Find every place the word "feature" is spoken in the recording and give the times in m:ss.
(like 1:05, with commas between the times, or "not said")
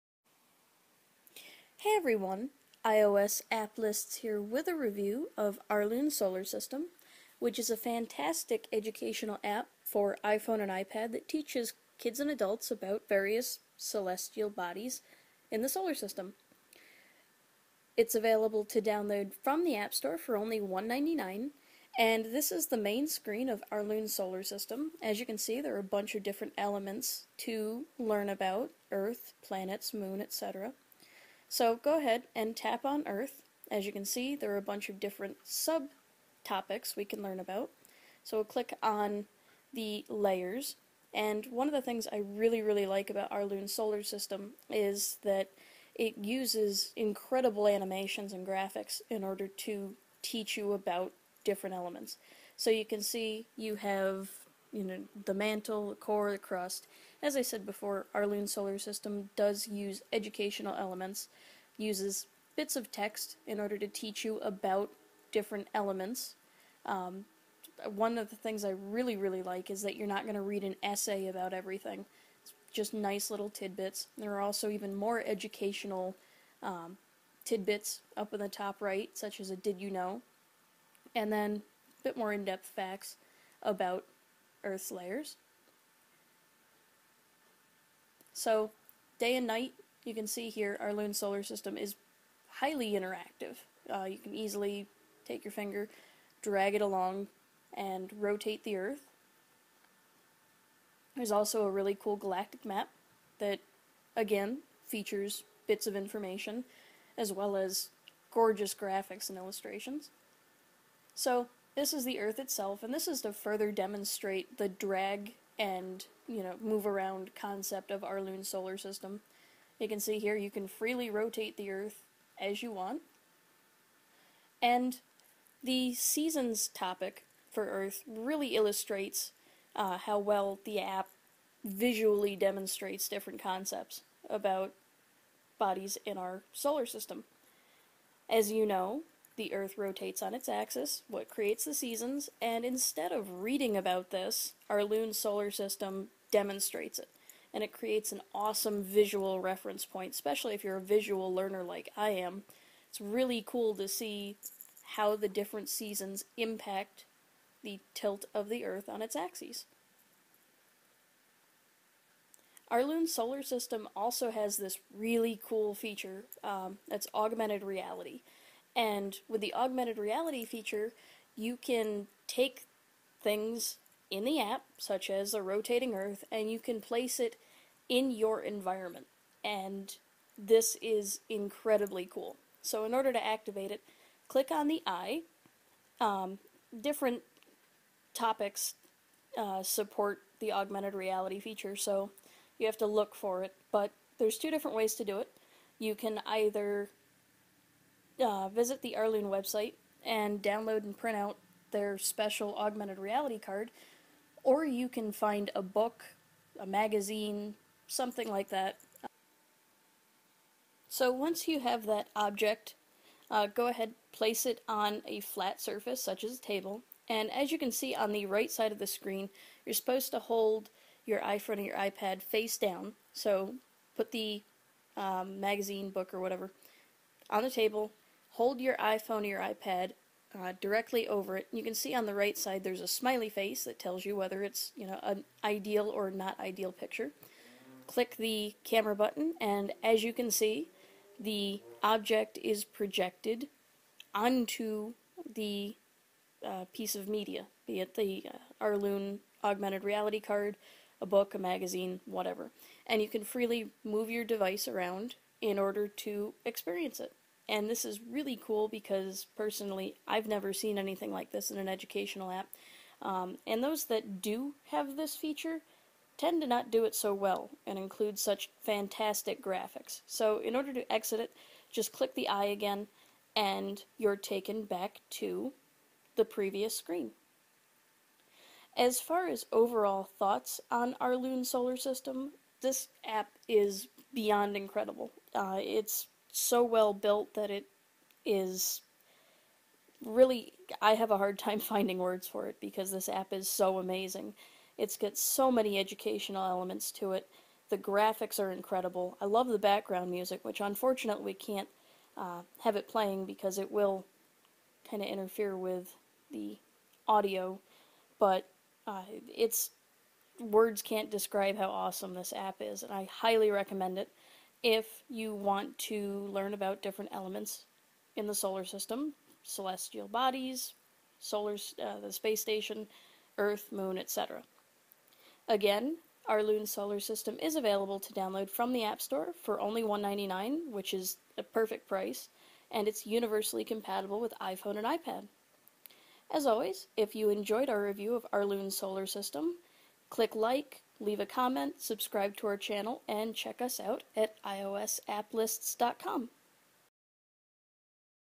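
1:44, 2:45, 2:50, 3:11, 4:25.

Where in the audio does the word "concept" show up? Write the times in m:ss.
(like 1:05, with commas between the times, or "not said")
1:57, 2:13.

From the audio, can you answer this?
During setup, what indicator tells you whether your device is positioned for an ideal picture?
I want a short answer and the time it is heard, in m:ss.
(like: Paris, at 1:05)
smiley face, at 3:52.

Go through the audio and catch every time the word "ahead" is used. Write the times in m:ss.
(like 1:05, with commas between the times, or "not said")
0:31, 3:33.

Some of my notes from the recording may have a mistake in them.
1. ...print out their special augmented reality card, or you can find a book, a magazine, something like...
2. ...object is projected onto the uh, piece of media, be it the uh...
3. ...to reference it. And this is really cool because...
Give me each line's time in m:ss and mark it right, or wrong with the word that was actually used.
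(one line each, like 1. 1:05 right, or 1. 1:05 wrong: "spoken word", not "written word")
1. 3:20 right
2. 4:01 right
3. 4:15 wrong: "experience", not "reference".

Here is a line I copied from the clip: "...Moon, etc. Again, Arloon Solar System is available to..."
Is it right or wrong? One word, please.
right.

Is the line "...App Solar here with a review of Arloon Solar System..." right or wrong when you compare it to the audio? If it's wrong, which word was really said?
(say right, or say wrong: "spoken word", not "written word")
wrong: "Lists", not "Solar".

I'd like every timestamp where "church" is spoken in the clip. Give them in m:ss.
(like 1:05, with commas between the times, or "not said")
not said.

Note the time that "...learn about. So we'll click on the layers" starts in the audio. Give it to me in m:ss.
0:37.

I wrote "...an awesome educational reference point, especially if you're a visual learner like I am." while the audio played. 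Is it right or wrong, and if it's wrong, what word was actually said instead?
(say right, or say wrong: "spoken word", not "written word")
wrong: "visual", not "educational".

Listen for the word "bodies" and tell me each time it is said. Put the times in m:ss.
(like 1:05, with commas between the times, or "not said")
0:14, 2:15, 5:20.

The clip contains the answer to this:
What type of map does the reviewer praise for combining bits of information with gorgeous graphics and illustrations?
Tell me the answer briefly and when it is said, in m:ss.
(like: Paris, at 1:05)
galactic map, at 1:42.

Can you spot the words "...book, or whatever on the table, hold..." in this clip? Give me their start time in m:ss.
3:45.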